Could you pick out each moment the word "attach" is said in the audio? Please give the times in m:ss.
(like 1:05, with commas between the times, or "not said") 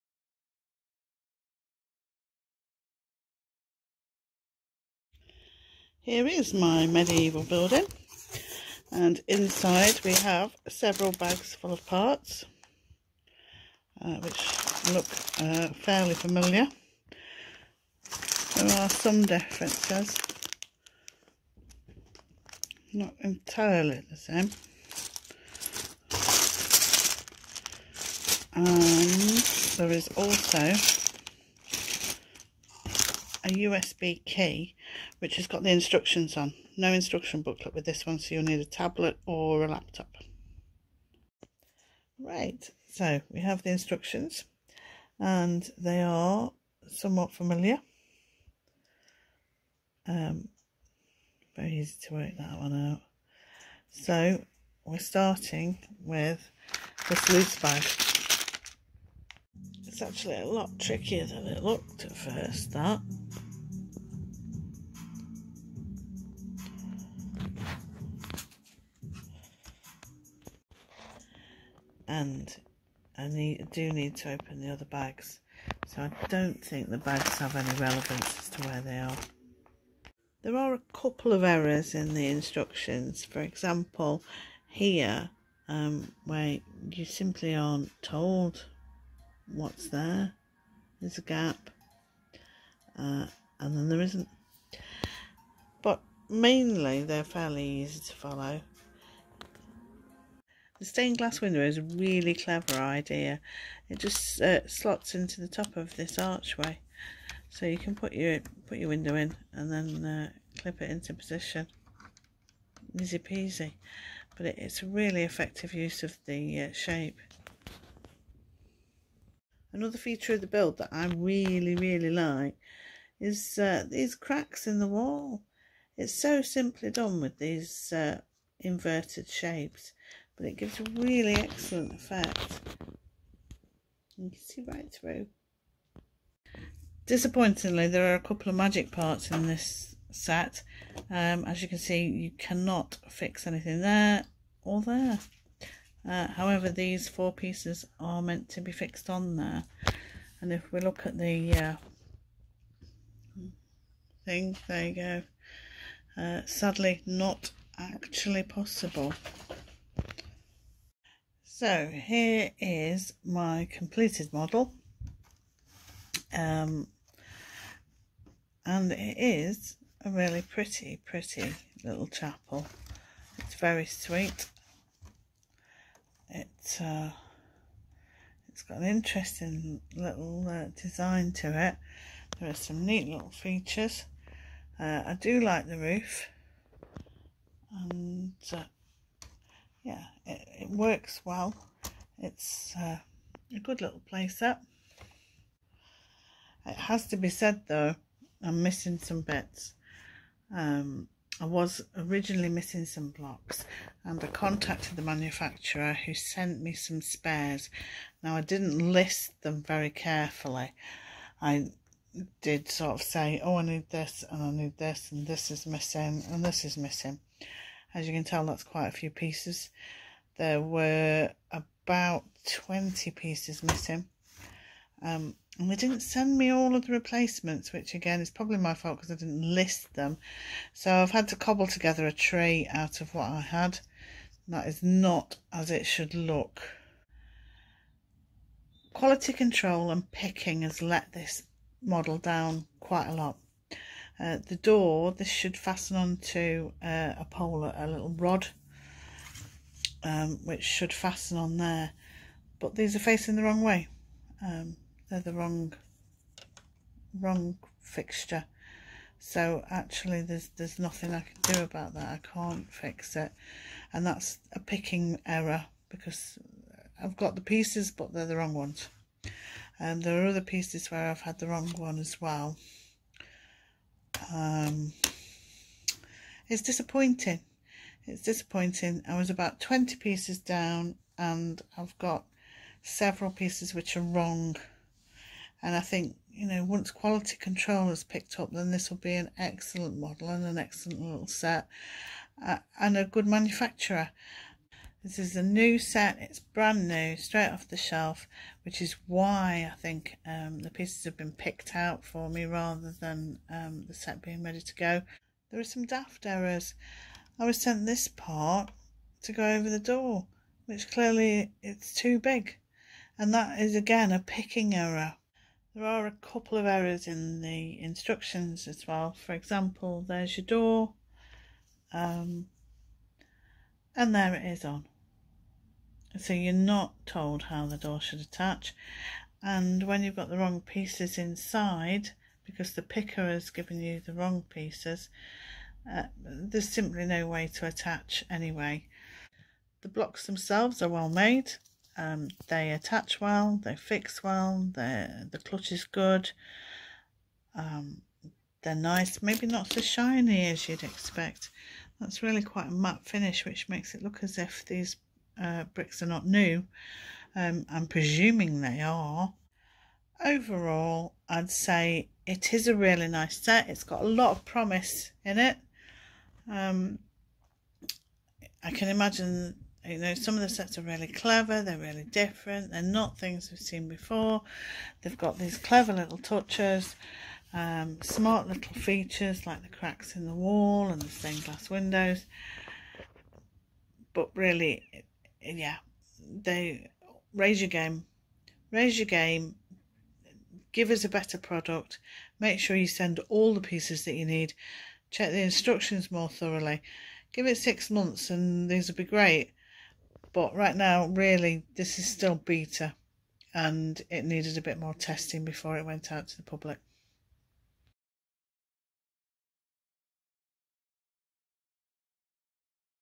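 5:28, 5:37, 5:42.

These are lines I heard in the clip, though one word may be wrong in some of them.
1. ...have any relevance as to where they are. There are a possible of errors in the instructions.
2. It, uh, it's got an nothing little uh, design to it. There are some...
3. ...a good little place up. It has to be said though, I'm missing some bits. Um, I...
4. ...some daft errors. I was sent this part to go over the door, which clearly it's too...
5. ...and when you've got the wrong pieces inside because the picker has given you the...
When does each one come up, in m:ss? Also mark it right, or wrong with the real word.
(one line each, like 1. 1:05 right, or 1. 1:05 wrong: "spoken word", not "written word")
1. 1:17 wrong: "couple", not "possible"
2. 2:56 wrong: "interesting", not "nothing"
3. 3:13 right
4. 5:05 right
5. 5:29 right.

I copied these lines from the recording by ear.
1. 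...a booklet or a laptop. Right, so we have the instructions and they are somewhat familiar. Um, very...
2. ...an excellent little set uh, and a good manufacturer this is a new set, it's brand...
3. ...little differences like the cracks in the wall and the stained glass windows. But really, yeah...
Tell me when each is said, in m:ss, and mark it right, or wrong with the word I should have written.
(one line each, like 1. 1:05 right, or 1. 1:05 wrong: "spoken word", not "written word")
1. 0:38 wrong: "tablet", not "booklet"
2. 4:50 right
3. 6:18 wrong: "features", not "differences".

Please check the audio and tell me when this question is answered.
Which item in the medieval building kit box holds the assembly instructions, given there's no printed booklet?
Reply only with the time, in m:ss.
0:33.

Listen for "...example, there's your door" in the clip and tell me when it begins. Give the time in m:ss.
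5:19.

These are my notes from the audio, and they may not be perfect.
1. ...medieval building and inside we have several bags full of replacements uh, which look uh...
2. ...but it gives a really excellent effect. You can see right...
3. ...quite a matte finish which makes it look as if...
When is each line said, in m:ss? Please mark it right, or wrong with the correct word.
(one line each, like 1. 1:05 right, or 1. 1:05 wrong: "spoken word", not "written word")
1. 0:06 wrong: "parts", not "replacements"
2. 2:10 right
3. 5:52 right.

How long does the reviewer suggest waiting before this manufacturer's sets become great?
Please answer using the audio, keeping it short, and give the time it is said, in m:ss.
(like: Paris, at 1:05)
6 months, at 6:37.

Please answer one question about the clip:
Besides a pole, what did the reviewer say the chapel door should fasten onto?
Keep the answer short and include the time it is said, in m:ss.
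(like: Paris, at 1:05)
a little rod, at 4:07.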